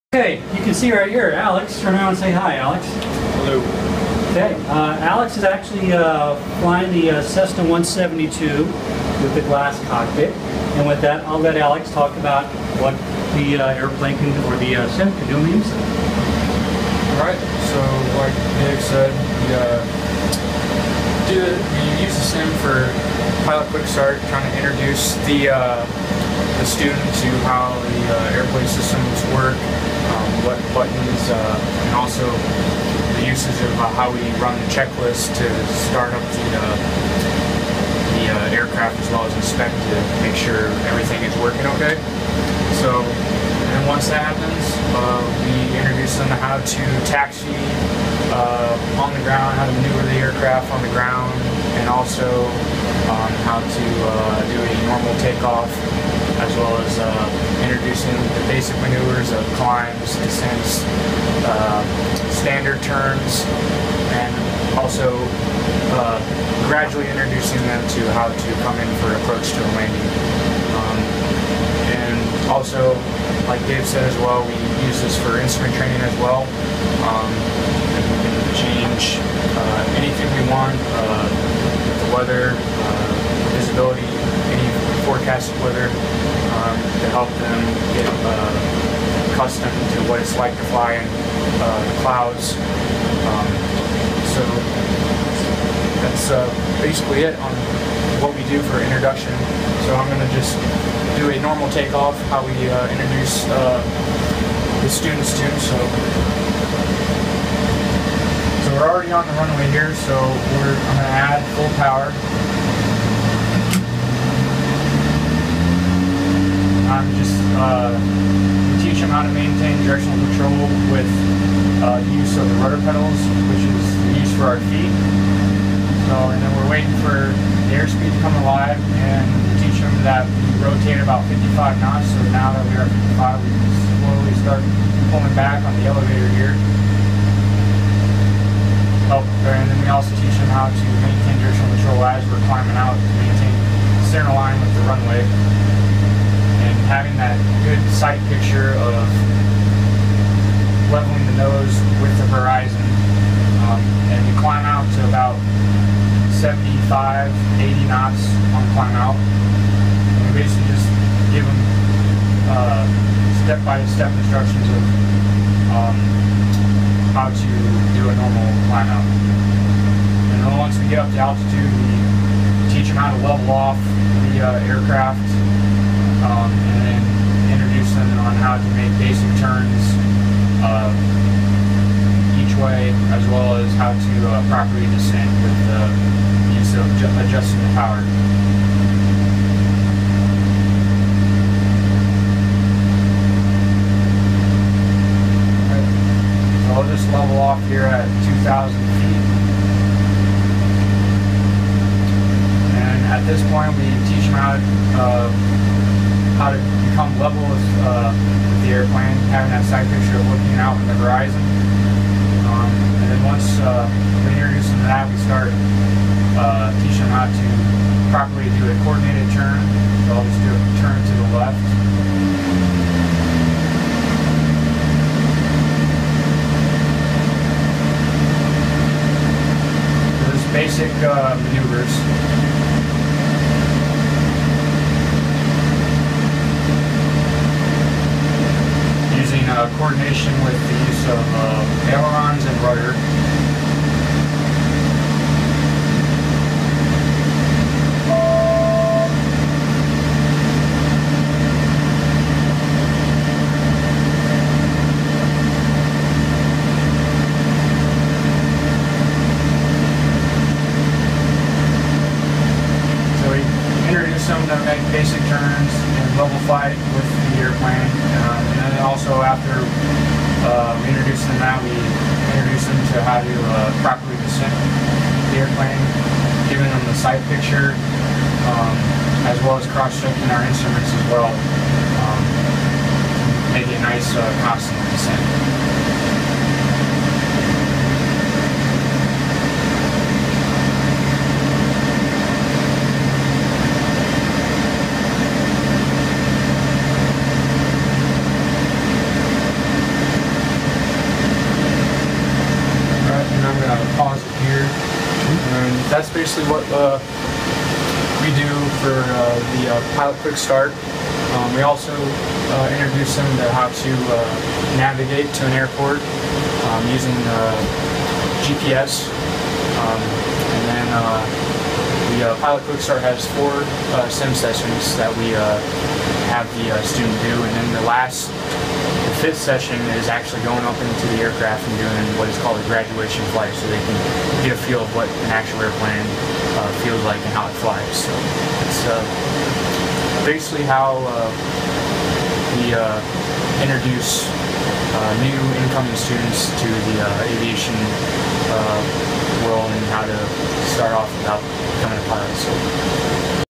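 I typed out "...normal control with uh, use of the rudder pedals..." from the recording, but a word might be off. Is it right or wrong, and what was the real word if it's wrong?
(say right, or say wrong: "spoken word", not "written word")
wrong: "directional", not "normal".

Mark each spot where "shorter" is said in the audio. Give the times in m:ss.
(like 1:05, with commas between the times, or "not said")
not said.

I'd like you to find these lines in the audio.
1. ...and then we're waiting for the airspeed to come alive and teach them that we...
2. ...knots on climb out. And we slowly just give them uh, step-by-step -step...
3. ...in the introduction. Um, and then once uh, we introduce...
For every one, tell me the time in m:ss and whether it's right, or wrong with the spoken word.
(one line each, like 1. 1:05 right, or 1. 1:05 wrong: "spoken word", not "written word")
1. 2:06 right
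2. 2:37 wrong: "basically", not "slowly"
3. 3:30 wrong: "horizon", not "introduction".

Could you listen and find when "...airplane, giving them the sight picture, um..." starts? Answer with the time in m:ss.
4:35.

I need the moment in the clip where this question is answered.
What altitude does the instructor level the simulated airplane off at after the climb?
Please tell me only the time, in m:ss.
3:18.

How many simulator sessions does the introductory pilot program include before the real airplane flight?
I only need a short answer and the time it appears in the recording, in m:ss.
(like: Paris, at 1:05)
4, at 5:23.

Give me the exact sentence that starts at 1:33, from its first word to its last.
Um, so that's uh, basically it on what we do for introduction.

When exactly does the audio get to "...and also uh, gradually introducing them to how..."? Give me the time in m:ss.
1:04.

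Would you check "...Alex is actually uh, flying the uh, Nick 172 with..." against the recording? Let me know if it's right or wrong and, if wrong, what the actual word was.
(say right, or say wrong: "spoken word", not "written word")
wrong: "Cessna", not "Nick".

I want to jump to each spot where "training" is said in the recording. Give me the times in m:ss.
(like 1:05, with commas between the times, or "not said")
1:15.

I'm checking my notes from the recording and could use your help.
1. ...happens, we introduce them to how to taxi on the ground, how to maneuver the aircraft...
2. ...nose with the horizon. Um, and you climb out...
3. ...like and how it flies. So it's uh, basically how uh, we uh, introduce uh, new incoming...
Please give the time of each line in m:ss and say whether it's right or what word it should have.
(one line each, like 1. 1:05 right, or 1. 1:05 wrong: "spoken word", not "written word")
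1. 0:44 right
2. 2:31 right
3. 5:37 right.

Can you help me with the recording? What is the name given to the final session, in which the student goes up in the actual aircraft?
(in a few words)
graduation flight.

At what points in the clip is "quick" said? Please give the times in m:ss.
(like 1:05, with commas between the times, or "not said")
0:23, 5:10, 5:22.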